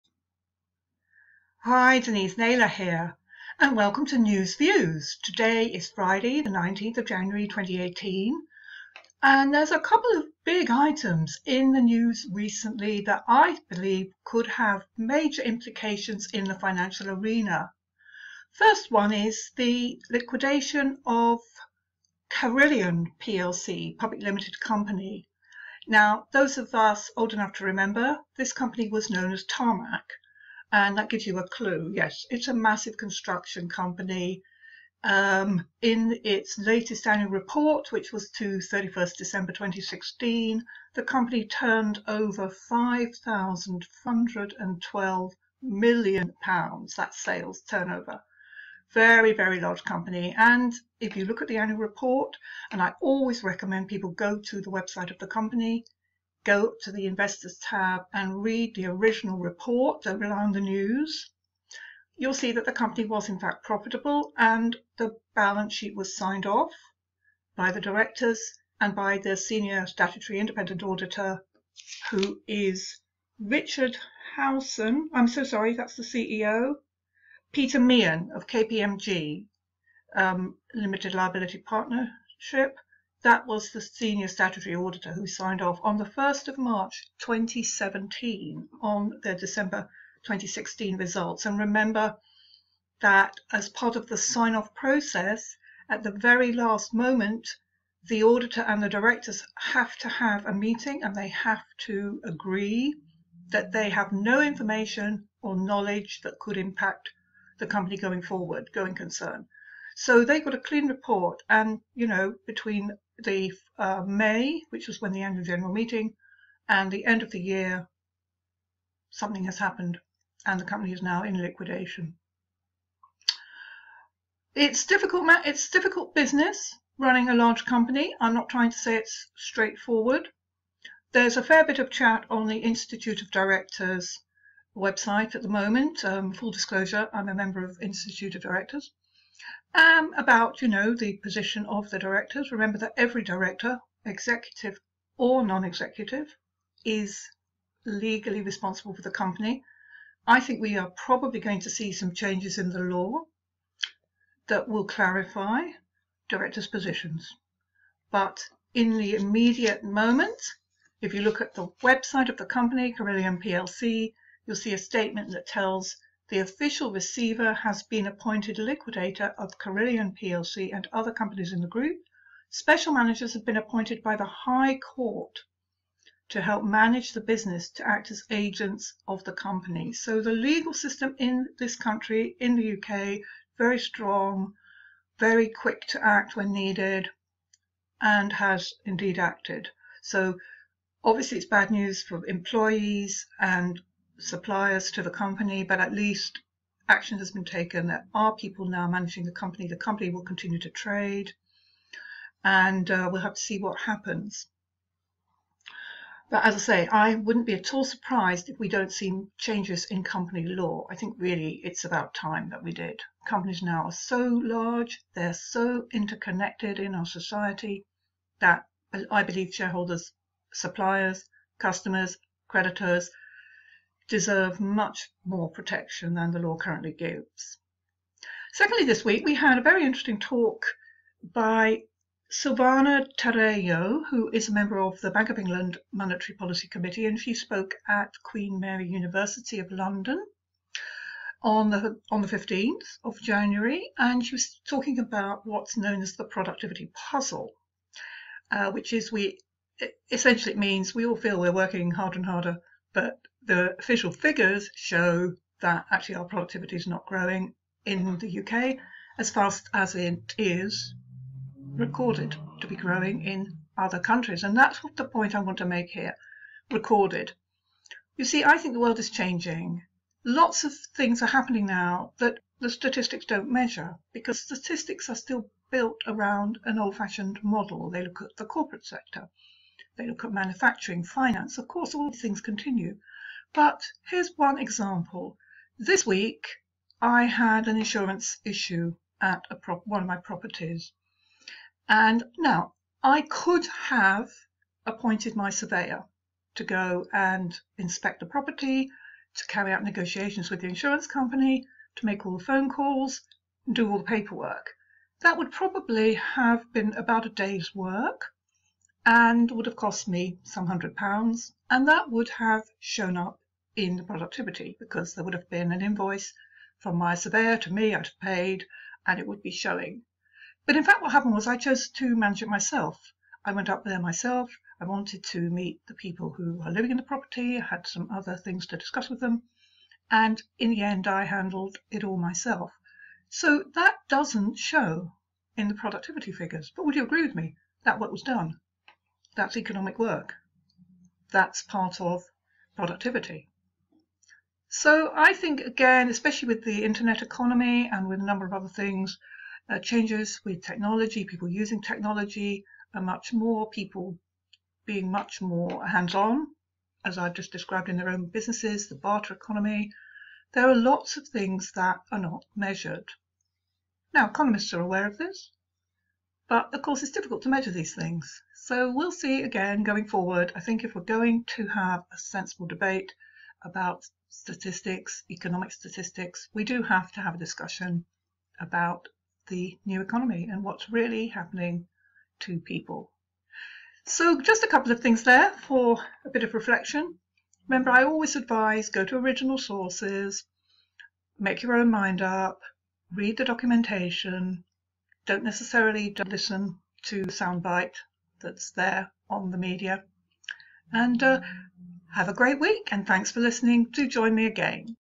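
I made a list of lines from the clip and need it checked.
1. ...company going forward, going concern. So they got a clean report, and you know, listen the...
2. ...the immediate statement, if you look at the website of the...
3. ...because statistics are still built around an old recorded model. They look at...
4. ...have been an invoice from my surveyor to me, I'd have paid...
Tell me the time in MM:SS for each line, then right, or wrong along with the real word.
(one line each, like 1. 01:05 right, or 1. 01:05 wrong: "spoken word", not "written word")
1. 01:47 wrong: "between", not "listen"
2. 02:38 wrong: "moment", not "statement"
3. 04:34 wrong: "fashioned", not "recorded"
4. 05:15 right.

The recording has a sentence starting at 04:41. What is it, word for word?
Of course, all these things continue.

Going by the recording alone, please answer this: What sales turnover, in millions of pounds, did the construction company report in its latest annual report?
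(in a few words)
5,112 million pounds.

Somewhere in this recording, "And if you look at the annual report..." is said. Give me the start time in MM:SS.
00:50.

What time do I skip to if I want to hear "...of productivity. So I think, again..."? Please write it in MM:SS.
05:42.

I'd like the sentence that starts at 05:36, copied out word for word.
But would you agree with me?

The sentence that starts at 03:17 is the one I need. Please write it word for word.
There are people now managing the company.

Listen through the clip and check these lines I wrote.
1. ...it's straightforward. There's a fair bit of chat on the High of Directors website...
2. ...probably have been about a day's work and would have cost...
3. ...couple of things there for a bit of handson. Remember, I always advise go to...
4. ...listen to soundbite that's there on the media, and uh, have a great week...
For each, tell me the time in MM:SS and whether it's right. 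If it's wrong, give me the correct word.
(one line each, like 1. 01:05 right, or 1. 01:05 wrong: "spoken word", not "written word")
1. 02:08 wrong: "Institute", not "High"
2. 05:05 right
3. 06:24 wrong: "reflection", not "handson"
4. 06:36 right.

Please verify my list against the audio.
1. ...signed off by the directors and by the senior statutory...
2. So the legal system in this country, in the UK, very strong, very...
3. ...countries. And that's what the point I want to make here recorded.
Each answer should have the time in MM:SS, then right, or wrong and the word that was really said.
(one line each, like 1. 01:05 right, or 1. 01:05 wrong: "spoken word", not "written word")
1. 01:06 right
2. 02:59 right
3. 04:23 right.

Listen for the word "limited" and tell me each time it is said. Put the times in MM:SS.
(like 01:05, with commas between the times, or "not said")
00:24, 01:20.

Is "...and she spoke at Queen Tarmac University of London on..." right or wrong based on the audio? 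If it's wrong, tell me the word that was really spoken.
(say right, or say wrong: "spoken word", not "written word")
wrong: "Mary", not "Tarmac".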